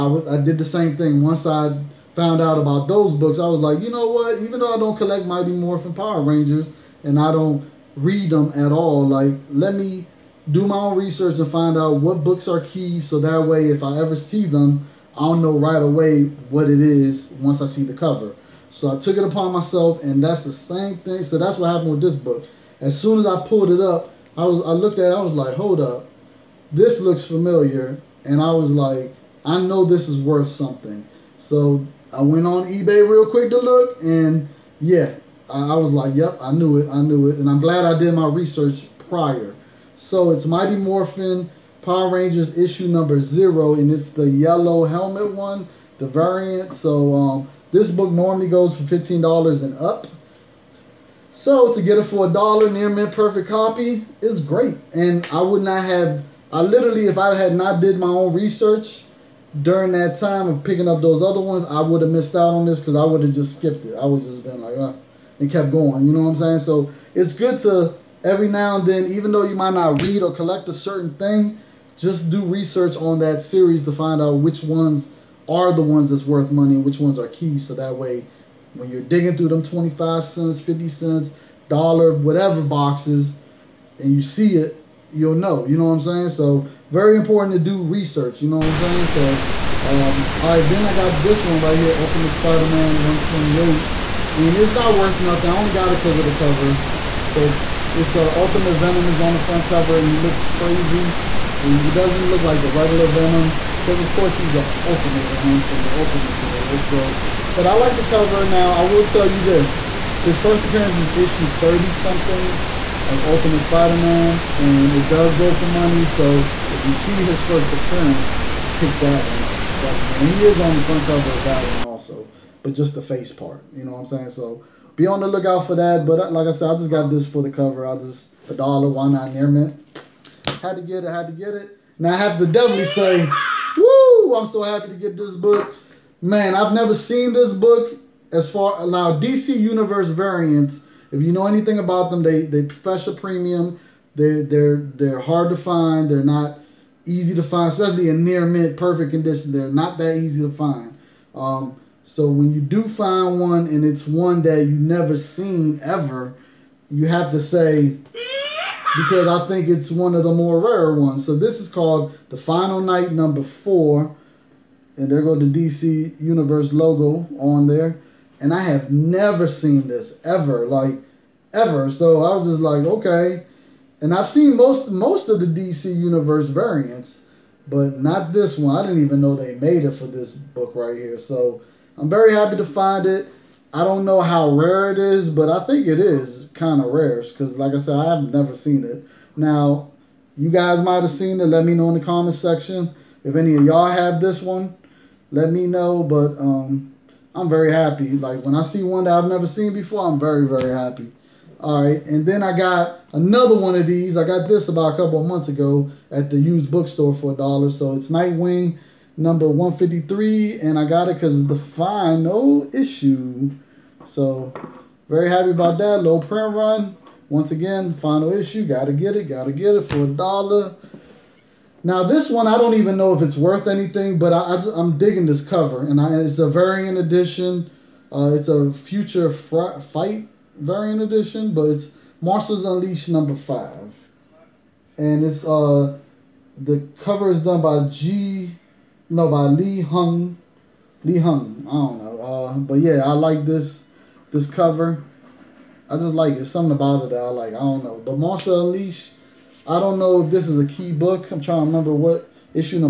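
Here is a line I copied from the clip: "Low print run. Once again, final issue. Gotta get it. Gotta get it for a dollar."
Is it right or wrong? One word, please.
right.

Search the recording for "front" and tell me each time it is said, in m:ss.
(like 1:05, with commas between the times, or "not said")
1:39, 2:00.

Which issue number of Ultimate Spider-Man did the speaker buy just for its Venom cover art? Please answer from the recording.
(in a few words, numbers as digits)
128.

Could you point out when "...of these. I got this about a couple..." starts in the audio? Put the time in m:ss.
3:23.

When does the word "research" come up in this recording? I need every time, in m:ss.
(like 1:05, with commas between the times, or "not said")
0:10, 0:38, 0:58, 1:12, 1:27.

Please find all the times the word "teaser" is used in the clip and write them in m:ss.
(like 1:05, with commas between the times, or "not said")
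not said.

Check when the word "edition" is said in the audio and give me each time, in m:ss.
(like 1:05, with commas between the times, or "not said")
3:46, 3:51.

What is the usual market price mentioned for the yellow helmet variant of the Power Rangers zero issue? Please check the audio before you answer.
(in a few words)
$15 and up.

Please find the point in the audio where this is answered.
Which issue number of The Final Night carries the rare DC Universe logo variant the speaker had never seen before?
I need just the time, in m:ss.
2:42.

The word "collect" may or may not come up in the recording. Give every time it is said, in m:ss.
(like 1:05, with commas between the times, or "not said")
0:04, 1:10.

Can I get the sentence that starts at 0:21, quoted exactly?
So that's what happened with this book.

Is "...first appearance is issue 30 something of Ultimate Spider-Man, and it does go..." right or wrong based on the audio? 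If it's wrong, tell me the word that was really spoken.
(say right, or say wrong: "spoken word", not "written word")
right.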